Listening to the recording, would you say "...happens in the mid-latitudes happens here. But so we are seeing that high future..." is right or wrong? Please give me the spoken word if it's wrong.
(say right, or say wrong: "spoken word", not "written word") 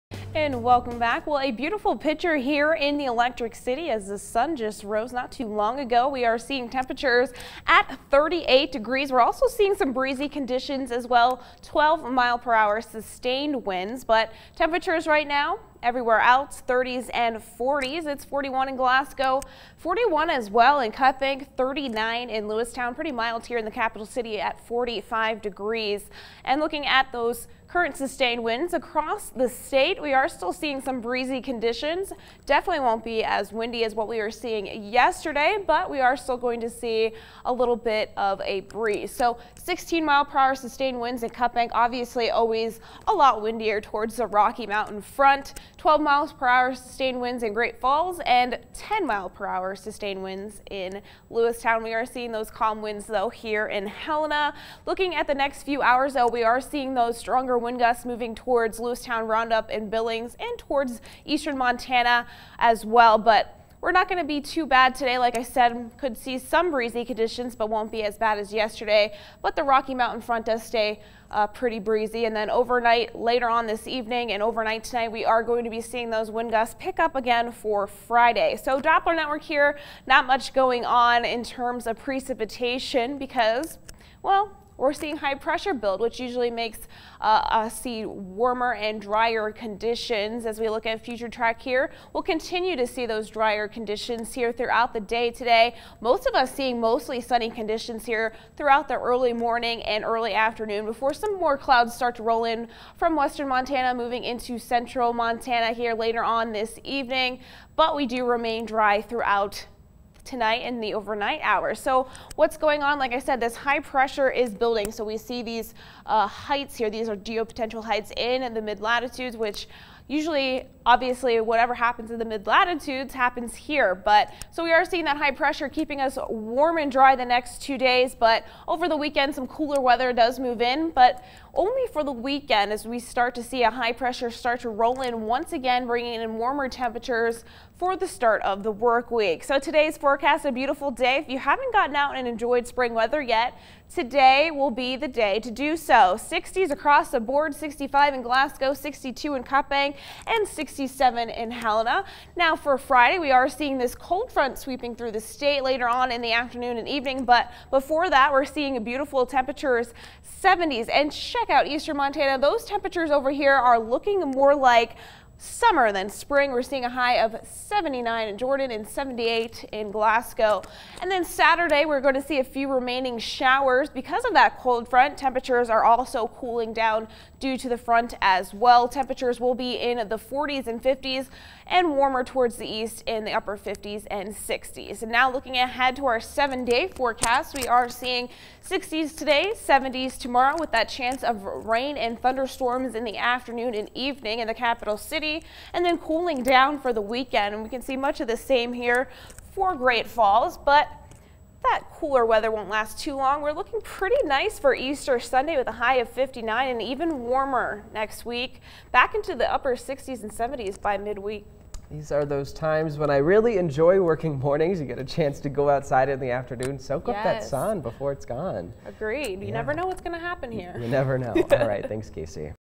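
wrong: "pressure", not "future".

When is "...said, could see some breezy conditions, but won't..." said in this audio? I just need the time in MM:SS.
01:05.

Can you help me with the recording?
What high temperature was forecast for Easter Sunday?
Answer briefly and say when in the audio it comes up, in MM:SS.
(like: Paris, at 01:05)
59, at 03:26.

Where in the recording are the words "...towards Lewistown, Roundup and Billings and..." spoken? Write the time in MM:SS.
00:58.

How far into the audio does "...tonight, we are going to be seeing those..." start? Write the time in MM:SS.
01:14.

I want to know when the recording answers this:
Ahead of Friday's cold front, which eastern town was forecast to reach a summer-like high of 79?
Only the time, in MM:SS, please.
02:48.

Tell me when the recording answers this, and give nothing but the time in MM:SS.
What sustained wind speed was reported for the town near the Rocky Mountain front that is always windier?
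00:39.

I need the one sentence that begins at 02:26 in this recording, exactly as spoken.
60s across the board, 65 in Glasgow, 62 in Cut Bank, and 67 in Helena.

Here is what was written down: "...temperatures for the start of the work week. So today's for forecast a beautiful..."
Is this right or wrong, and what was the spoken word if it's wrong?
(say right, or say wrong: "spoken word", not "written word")
right.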